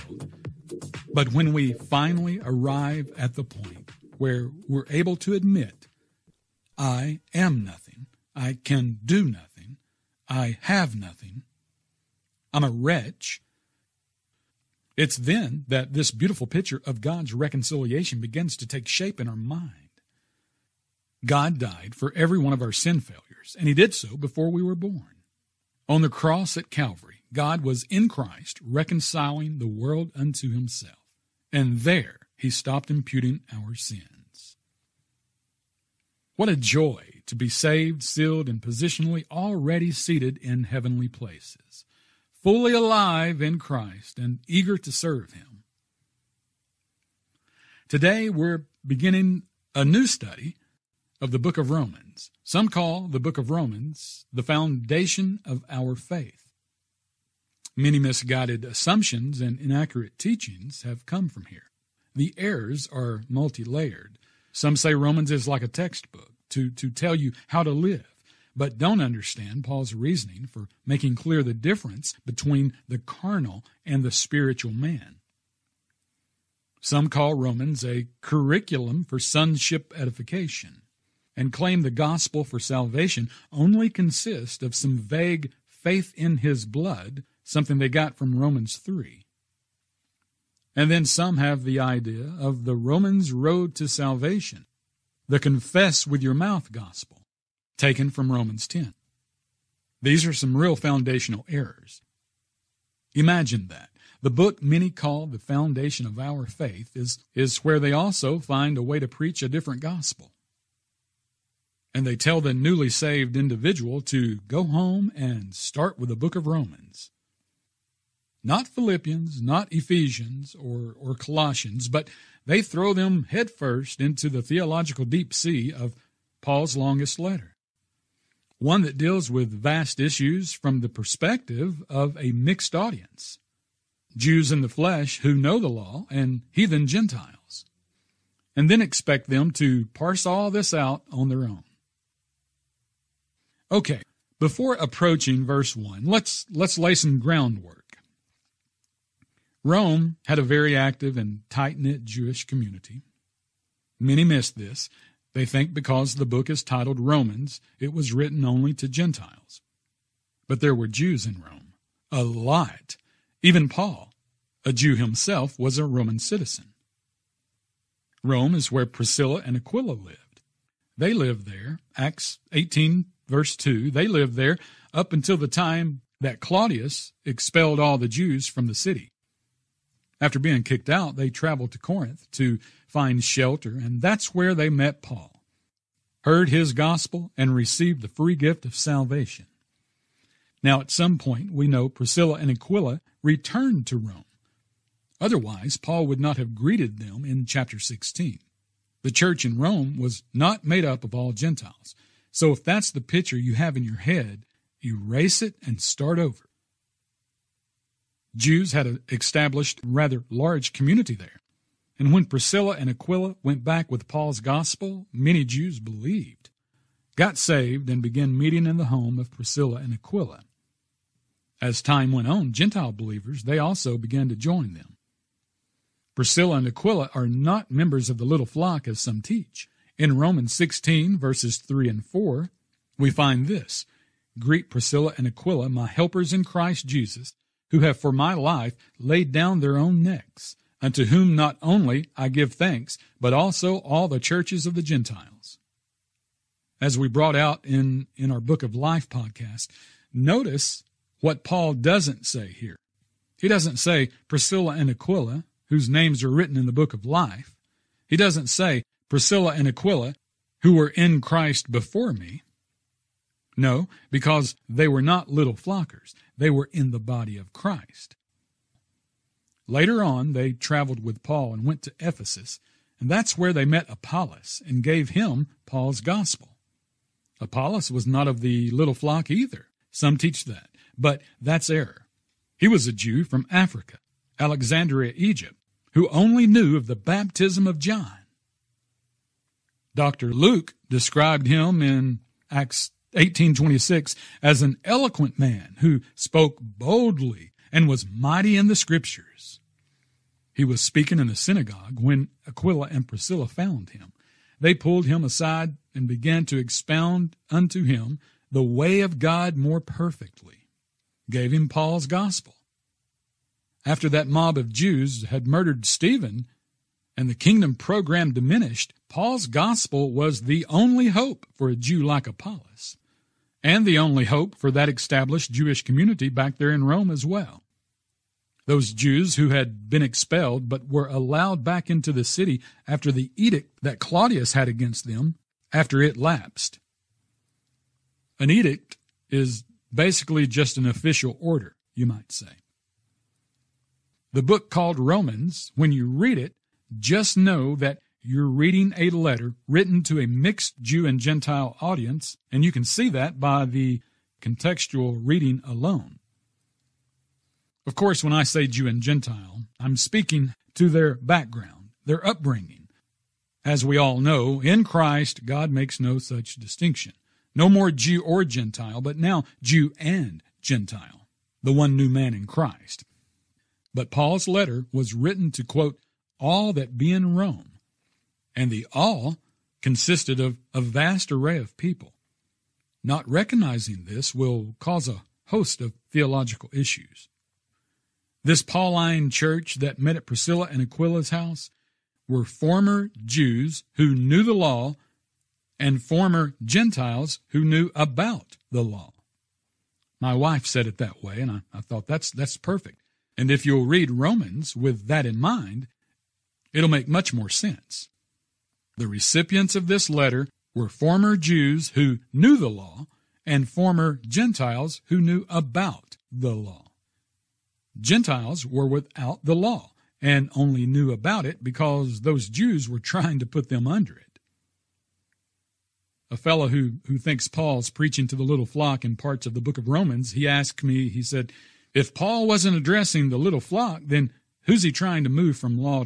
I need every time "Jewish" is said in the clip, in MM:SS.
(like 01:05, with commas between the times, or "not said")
02:32, 05:25.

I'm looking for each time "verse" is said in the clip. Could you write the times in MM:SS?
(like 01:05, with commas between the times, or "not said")
02:25, 02:53, 03:51.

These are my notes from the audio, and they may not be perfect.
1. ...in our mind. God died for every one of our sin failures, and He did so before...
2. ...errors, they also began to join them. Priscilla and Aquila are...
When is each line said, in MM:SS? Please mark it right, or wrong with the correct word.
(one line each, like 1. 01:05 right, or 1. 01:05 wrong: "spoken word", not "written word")
1. 00:19 right
2. 03:42 wrong: "believers", not "errors".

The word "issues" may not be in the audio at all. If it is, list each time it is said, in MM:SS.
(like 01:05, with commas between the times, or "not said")
02:09, 06:26.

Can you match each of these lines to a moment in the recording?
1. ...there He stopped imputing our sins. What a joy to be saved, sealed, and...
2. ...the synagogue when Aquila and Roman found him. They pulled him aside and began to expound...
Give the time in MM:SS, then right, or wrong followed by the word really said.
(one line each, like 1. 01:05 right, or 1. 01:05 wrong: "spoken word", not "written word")
1. 00:31 right
2. 05:01 wrong: "Priscilla", not "Roman".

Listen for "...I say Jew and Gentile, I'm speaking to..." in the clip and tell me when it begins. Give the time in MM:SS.
05:58.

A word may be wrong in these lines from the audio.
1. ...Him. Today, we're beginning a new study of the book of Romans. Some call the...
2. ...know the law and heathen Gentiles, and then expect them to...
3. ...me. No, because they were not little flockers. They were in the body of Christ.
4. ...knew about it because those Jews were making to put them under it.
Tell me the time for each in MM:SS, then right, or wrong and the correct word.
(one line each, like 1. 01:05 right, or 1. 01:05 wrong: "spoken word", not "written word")
1. 00:45 right
2. 02:15 right
3. 04:22 right
4. 07:00 wrong: "trying", not "making".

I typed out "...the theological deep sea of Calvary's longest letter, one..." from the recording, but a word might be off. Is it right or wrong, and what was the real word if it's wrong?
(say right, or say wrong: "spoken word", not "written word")
wrong: "Paul", not "Calvary".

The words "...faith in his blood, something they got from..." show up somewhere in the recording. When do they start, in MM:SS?
01:25.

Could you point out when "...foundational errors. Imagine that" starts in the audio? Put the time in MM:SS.
01:40.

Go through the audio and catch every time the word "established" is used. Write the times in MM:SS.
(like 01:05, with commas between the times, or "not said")
03:29, 05:24.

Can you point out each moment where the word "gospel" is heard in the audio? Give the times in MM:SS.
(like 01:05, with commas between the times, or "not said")
01:21, 01:36, 01:49, 03:06, 03:34, 04:36, 05:12, 05:19.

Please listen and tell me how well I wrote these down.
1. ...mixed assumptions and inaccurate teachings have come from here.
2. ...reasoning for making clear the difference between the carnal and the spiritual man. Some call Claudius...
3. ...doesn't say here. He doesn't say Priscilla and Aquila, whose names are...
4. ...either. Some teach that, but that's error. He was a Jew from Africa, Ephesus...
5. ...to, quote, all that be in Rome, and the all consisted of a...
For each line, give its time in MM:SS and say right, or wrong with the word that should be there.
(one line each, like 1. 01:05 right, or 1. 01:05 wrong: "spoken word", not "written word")
1. 00:57 wrong: "misguided", not "mixed"
2. 01:09 wrong: "Romans", not "Claudius"
3. 04:11 right
4. 04:39 wrong: "Alexandria", not "Ephesus"
5. 06:15 right.